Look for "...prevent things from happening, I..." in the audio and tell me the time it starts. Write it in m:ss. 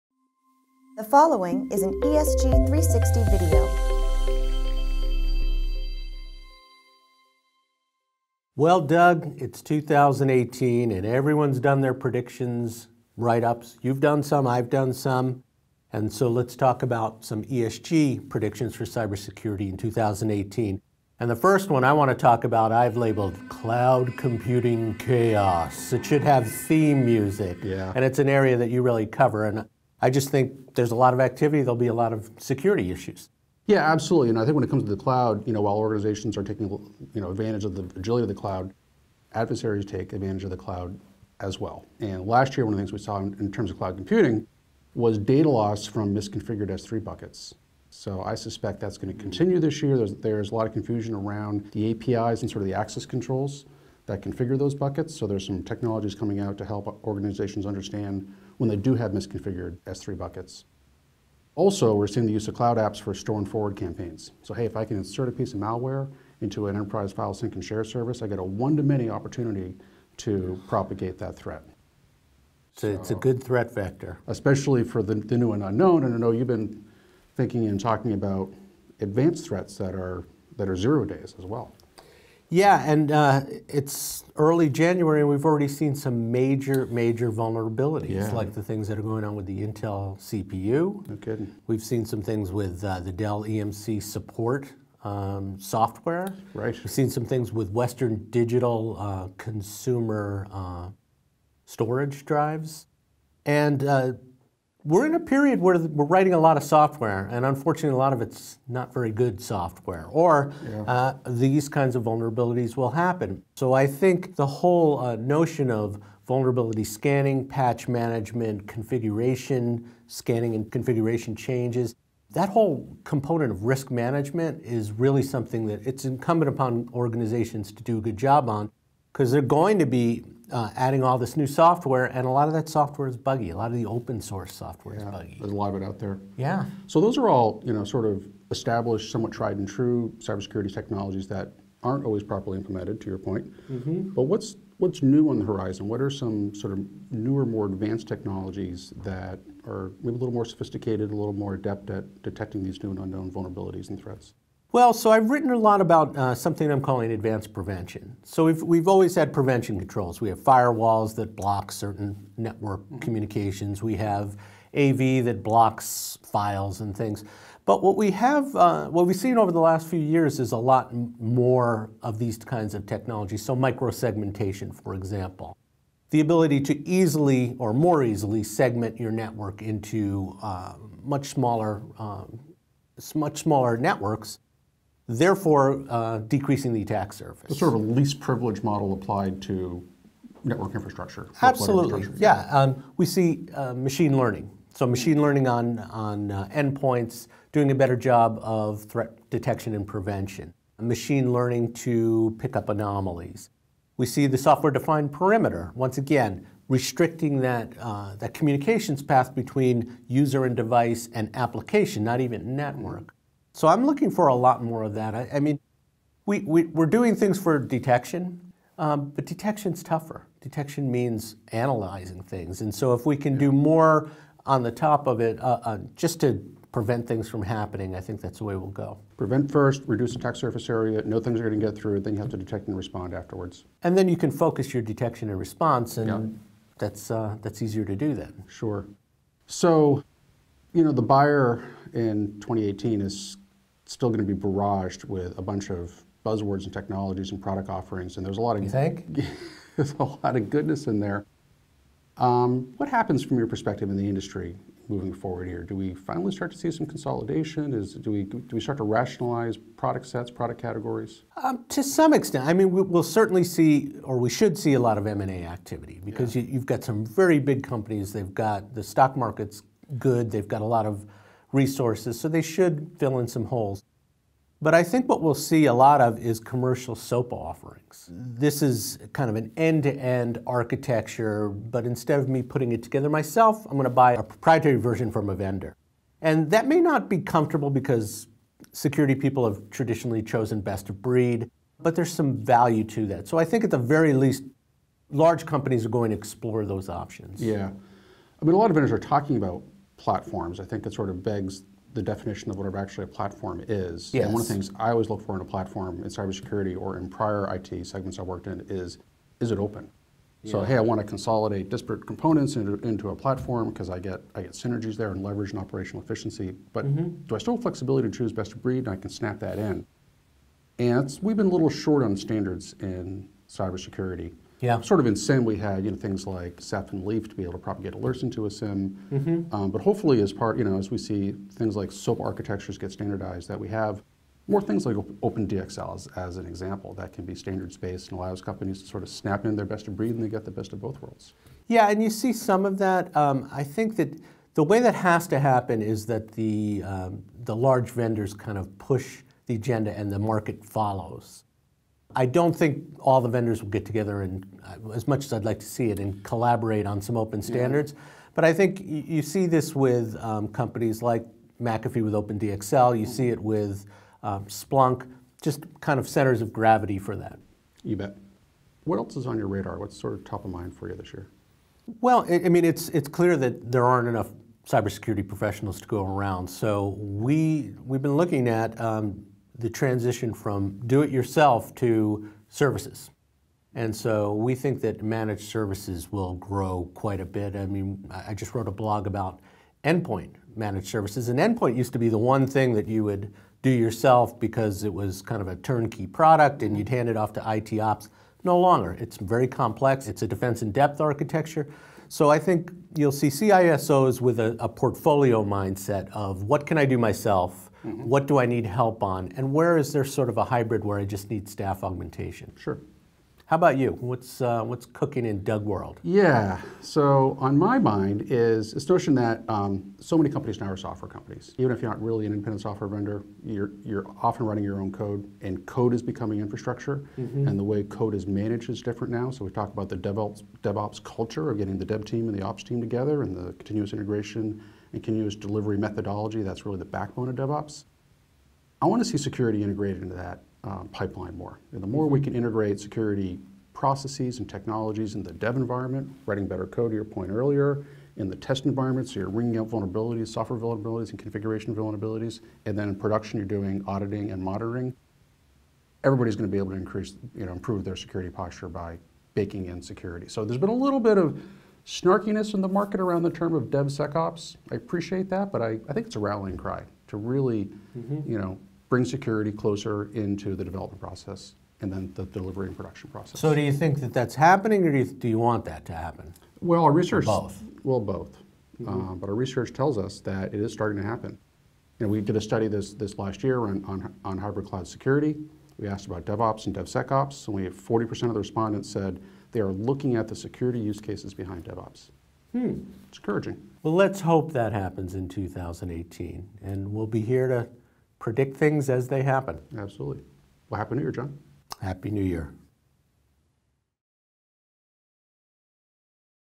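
3:46.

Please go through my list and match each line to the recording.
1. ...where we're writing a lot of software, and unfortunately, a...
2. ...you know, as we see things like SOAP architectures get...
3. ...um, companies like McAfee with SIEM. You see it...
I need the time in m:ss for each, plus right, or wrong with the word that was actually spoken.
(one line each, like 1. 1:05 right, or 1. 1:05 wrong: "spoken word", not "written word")
1. 1:45 right
2. 5:30 right
3. 6:00 wrong: "OpenDXL", not "SIEM".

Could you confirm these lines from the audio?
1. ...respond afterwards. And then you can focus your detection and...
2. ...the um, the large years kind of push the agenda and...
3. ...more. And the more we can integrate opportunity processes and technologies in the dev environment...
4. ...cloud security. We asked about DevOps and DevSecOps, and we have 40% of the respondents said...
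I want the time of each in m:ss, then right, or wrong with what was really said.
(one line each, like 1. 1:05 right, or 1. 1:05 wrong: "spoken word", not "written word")
1. 3:52 right
2. 5:46 wrong: "vendors", not "years"
3. 7:21 wrong: "security", not "opportunity"
4. 8:04 right.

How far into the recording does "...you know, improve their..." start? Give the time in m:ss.
7:37.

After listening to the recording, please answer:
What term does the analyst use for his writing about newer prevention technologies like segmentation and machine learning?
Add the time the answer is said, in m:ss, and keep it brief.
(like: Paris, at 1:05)
advanced prevention, at 2:37.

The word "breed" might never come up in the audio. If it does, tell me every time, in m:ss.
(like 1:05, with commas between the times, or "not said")
4:51, 5:18, 5:39.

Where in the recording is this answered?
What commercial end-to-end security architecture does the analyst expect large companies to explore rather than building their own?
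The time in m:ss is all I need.
4:36.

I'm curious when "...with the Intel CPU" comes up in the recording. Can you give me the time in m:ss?
1:29.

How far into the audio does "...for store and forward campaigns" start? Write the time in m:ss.
1:02.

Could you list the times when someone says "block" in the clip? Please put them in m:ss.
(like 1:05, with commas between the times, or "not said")
2:41, 2:45.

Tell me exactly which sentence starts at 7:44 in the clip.
I appreciate that, but I, I think it's a rallying cry to really, mm -hmm.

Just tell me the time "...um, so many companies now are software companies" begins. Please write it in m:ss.
6:59.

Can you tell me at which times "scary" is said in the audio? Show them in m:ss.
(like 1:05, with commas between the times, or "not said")
not said.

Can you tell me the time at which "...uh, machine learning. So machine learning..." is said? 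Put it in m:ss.
3:13.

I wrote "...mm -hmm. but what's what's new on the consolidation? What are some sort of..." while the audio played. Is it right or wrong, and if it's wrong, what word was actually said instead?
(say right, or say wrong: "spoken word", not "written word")
wrong: "horizon", not "consolidation".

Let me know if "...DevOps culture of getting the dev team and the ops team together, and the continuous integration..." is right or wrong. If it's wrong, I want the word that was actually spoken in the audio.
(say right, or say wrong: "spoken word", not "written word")
right.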